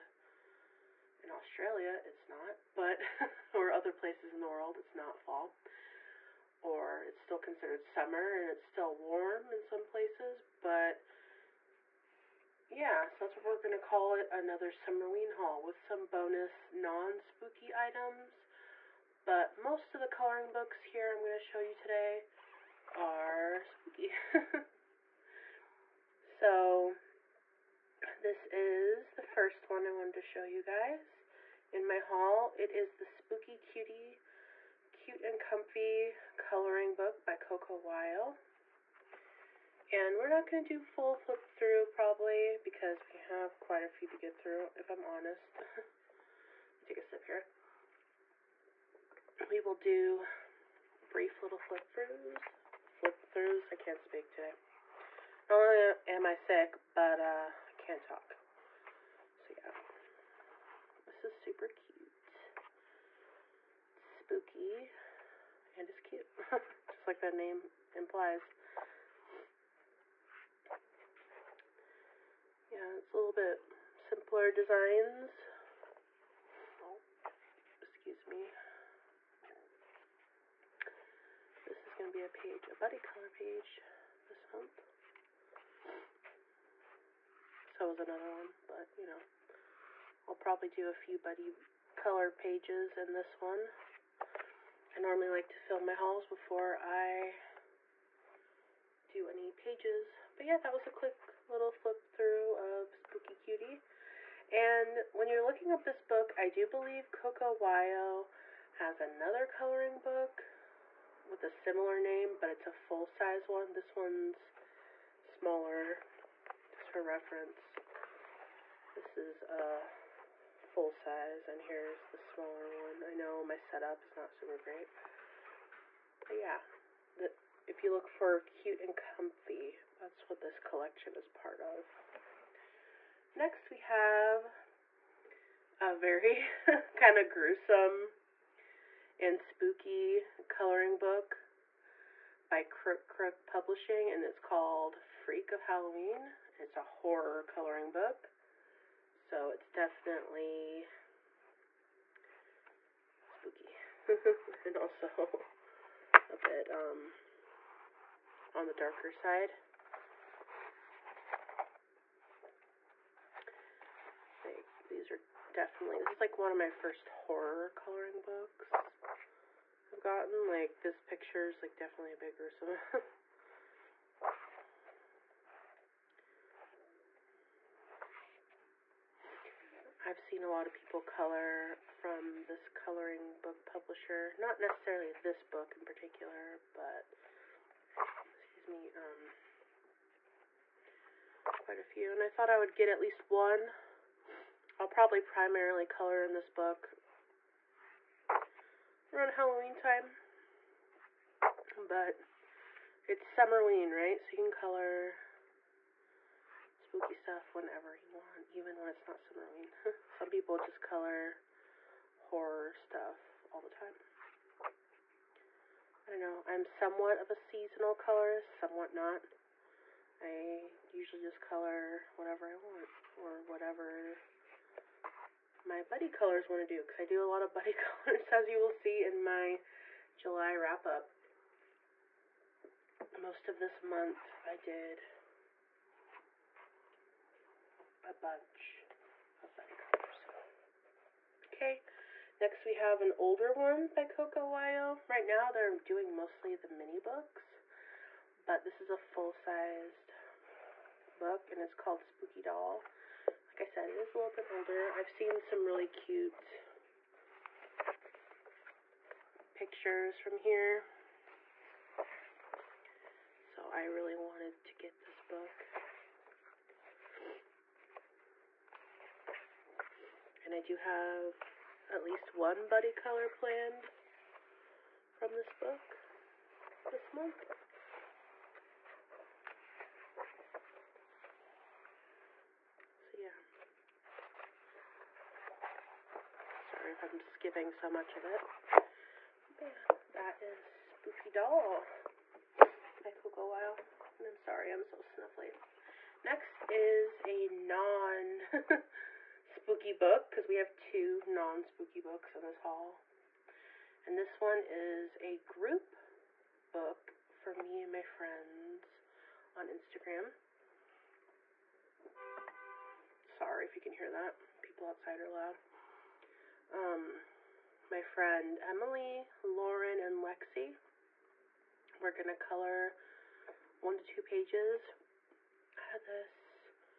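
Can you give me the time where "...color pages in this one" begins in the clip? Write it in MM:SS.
01:31.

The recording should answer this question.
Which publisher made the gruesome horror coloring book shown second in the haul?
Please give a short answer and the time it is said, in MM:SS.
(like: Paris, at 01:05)
Crook Crook Publishing, at 02:22.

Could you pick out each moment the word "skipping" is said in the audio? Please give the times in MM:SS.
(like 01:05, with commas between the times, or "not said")
04:47.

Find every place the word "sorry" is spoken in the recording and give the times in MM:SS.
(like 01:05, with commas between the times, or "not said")
04:46, 04:54, 05:13.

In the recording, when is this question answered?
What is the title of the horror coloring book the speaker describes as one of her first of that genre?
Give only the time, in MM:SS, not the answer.
02:25.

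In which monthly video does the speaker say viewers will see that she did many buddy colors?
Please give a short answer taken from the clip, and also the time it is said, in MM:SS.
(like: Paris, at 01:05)
July wrap up, at 03:50.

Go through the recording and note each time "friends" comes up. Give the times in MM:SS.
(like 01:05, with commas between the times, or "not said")
05:08, 05:18.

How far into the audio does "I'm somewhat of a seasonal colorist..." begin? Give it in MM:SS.
03:36.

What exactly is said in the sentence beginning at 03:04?
Not necessarily this book in particular, but excuse me, um, quite a few.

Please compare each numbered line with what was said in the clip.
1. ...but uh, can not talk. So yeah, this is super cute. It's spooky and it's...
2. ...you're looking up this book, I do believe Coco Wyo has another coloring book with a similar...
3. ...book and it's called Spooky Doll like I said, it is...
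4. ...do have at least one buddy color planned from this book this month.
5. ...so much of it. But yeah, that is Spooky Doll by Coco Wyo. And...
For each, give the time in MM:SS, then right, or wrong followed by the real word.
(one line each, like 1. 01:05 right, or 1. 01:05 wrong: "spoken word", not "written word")
1. 00:56 right
2. 01:45 right
3. 04:11 right
4. 04:30 right
5. 04:47 right.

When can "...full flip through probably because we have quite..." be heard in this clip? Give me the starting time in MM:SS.
00:40.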